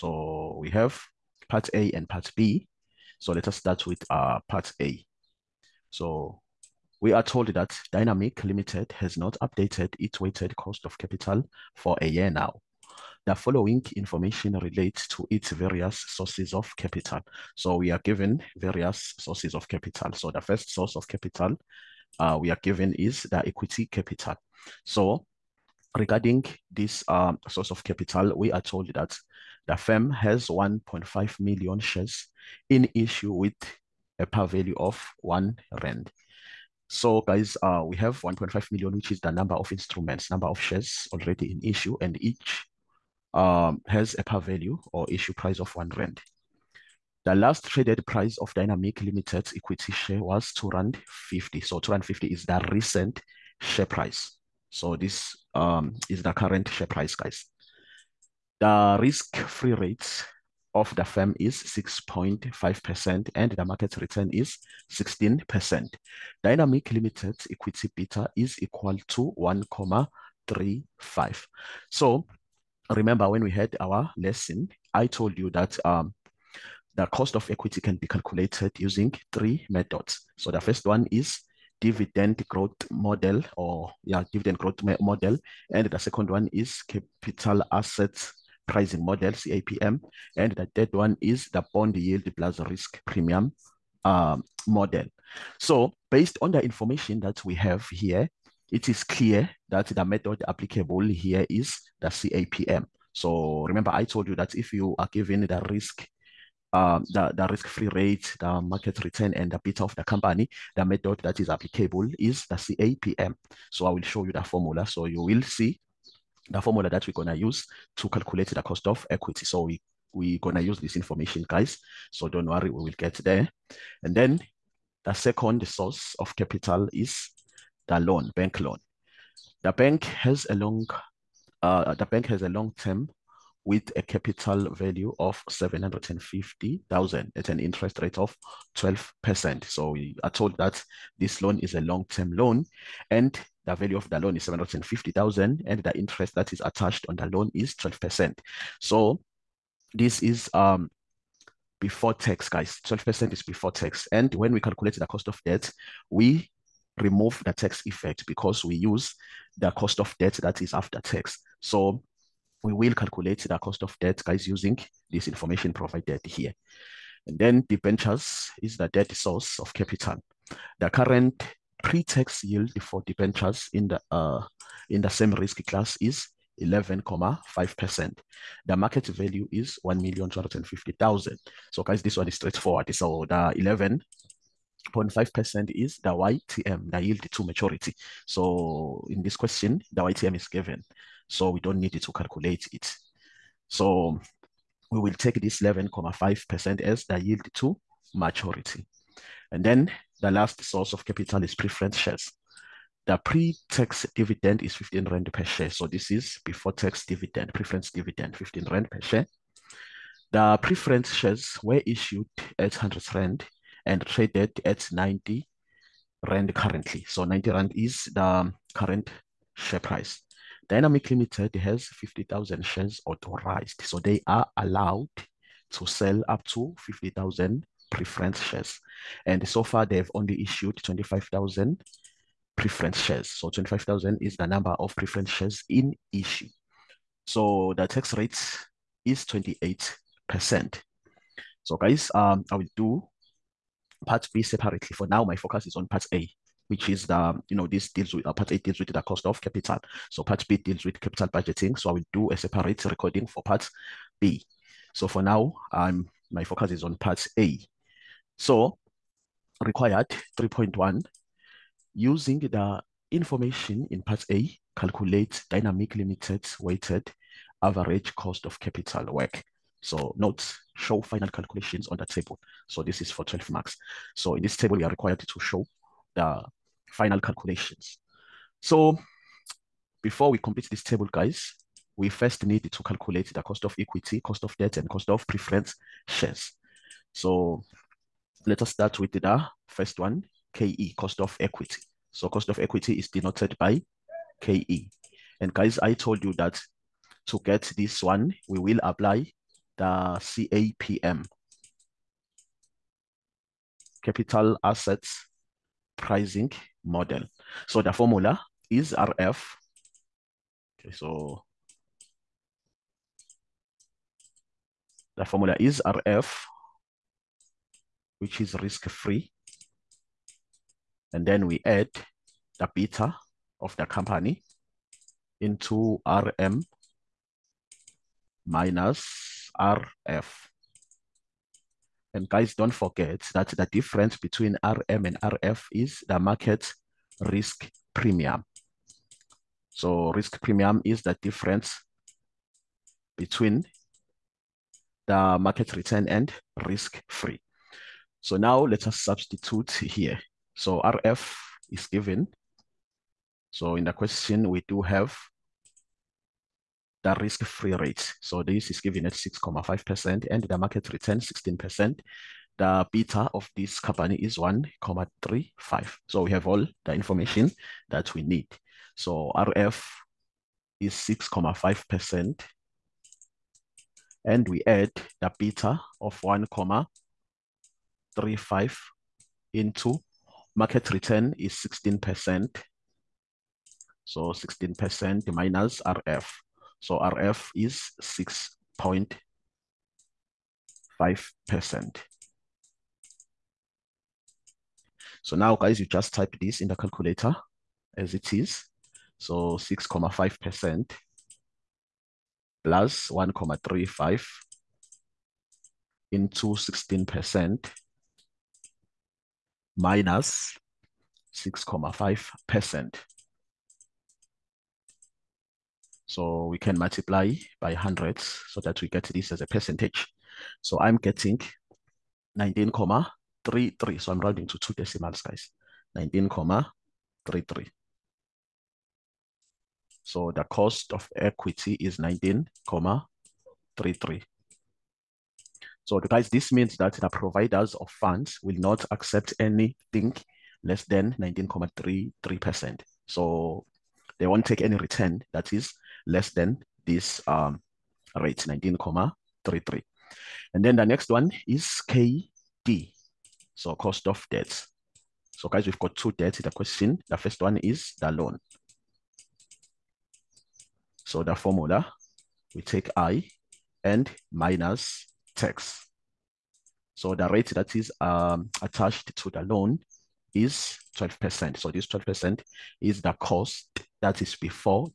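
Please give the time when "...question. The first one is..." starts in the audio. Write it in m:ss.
7:36.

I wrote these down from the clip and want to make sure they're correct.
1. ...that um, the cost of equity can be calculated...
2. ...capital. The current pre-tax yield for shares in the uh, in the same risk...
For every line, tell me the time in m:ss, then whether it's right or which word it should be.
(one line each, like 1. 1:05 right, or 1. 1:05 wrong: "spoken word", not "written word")
1. 1:15 right
2. 2:49 wrong: "debentures", not "shares".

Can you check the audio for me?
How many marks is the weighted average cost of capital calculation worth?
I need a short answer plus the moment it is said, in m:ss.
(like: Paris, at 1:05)
12, at 4:33.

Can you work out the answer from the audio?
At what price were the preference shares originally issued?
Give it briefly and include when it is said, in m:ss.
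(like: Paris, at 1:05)
100 Rand, at 3:32.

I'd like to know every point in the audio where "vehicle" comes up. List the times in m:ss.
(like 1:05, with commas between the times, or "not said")
not said.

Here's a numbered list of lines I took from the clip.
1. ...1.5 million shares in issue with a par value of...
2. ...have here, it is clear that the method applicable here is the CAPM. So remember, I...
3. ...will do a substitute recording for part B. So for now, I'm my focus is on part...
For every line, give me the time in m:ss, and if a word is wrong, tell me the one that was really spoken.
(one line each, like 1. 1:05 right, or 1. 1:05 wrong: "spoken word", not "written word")
1. 0:30 right
2. 1:37 right
3. 4:11 wrong: "separate", not "substitute".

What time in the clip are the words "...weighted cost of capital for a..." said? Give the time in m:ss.
0:10.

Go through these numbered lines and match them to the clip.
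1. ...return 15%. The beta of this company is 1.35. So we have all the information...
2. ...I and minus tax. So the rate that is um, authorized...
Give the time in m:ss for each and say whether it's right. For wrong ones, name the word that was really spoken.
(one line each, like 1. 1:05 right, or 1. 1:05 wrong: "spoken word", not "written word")
1. 6:00 wrong: "16", not "15"
2. 7:42 wrong: "attached", not "authorized".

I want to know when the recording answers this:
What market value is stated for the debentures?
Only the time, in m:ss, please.
2:59.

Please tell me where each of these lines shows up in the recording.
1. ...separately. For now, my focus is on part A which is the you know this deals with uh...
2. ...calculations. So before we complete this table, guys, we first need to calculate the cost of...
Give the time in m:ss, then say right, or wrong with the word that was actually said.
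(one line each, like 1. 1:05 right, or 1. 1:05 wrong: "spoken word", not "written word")
1. 4:04 right
2. 4:37 right.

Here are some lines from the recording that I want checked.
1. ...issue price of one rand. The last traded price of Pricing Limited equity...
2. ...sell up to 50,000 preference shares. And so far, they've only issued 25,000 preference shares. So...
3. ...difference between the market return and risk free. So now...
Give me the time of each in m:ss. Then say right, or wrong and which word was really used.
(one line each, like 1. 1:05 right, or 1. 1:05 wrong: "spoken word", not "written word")
1. 0:45 wrong: "Dynamic", not "Pricing"
2. 3:45 right
3. 5:41 right.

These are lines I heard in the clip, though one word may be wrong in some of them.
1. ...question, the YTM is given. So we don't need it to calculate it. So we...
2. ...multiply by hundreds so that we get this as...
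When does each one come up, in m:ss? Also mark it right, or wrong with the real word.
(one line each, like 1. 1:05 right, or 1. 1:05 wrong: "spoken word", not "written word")
1. 3:09 right
2. 6:56 right.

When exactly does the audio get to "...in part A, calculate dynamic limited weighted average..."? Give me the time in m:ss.
4:23.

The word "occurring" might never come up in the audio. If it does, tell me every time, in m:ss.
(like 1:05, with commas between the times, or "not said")
not said.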